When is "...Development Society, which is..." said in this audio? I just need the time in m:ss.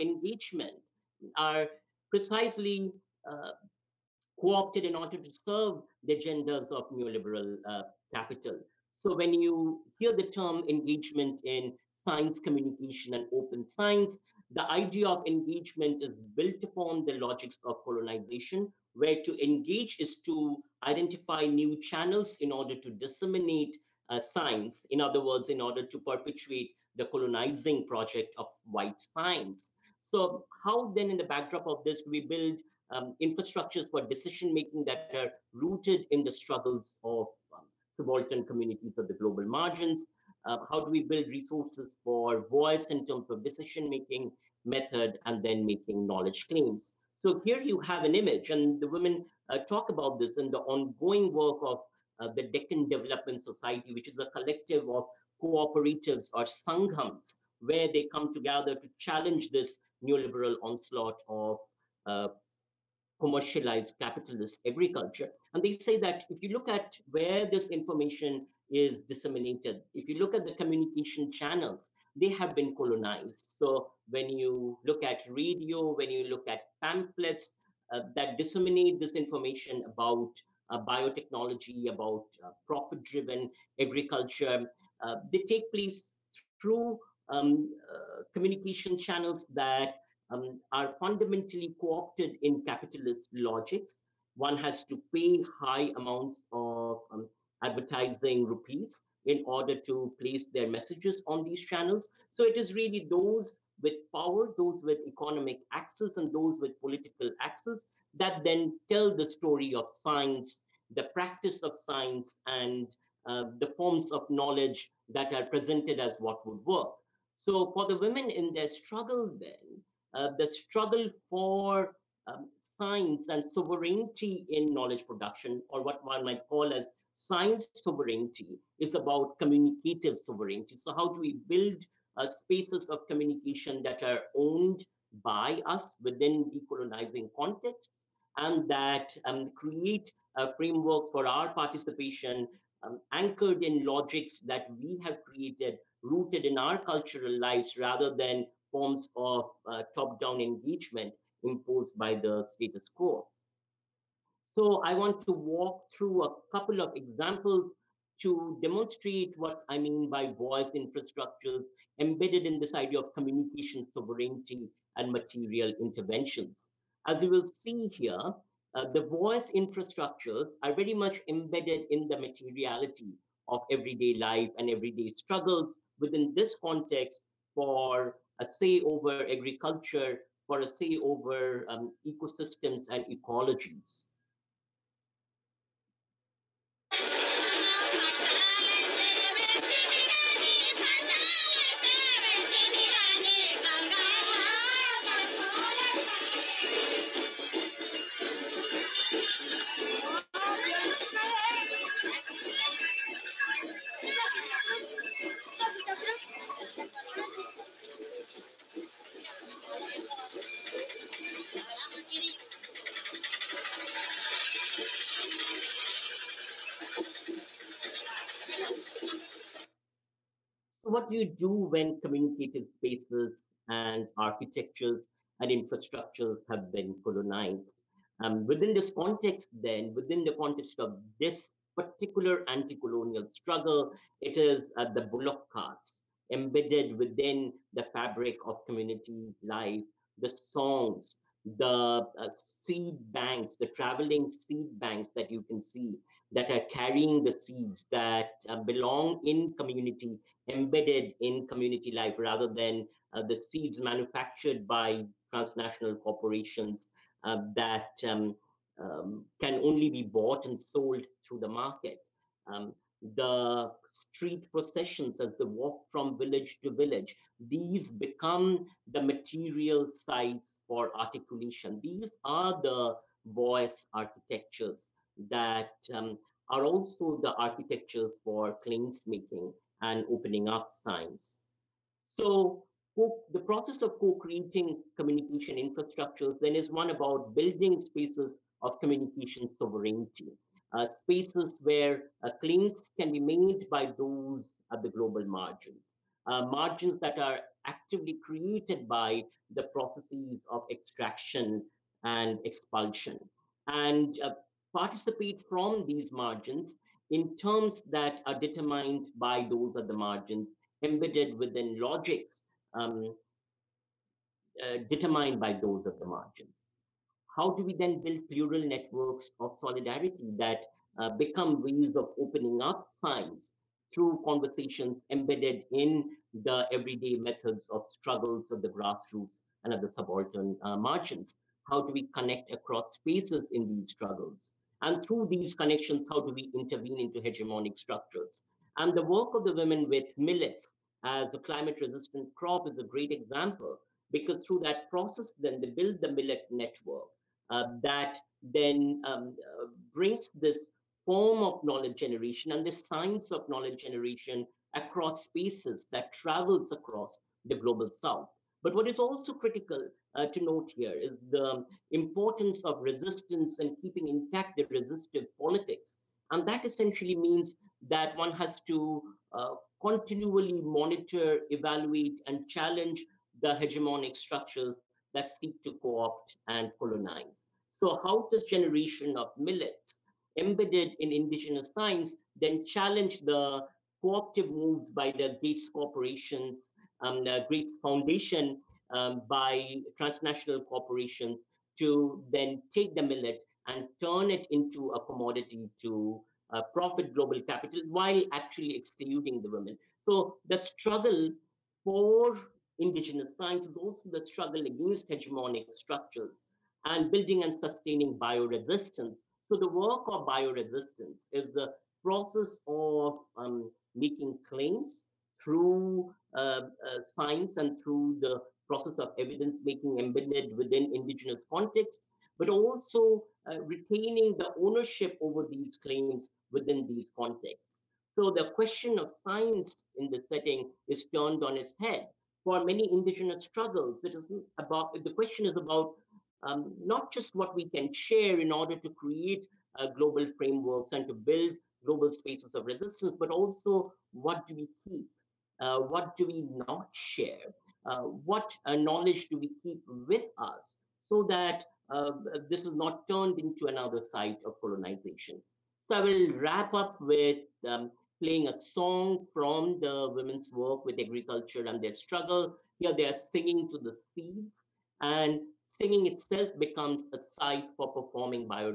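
0:52.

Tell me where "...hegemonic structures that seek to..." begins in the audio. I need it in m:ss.
6:13.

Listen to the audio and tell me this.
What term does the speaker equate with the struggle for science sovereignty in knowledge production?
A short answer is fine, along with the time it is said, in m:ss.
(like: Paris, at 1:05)
communicative sovereignty, at 2:09.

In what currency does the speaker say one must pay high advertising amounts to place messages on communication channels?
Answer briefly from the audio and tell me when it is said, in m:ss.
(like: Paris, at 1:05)
rupees, at 1:38.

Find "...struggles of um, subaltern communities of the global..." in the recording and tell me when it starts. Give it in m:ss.
0:36.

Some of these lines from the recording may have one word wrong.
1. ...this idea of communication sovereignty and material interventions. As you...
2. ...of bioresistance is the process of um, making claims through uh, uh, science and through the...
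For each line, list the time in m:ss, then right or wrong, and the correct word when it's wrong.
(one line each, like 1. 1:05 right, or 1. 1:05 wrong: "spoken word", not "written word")
1. 2:42 right
2. 6:50 right.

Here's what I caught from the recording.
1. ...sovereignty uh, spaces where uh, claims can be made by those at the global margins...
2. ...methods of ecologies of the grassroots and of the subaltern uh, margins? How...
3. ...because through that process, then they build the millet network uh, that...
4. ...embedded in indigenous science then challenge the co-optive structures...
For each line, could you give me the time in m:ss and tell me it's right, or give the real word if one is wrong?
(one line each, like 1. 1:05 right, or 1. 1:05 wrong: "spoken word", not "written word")
1. 4:49 right
2. 5:27 wrong: "struggles", not "ecologies"
3. 5:44 right
4. 6:20 wrong: "moves", not "structures".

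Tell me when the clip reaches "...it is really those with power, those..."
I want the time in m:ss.
1:42.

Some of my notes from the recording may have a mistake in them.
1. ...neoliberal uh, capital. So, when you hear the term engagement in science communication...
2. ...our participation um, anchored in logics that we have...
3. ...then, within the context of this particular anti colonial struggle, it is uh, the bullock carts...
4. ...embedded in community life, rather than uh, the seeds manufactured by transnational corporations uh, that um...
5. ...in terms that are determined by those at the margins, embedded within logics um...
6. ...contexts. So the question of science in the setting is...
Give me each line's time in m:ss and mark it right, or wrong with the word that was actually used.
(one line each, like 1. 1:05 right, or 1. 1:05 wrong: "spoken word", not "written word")
1. 0:06 right
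2. 2:21 right
3. 3:49 right
4. 4:10 right
5. 5:07 right
6. 7:07 right.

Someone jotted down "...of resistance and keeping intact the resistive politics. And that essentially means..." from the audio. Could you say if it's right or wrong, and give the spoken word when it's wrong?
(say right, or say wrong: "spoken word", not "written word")
right.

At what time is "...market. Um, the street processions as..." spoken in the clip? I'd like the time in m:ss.
4:21.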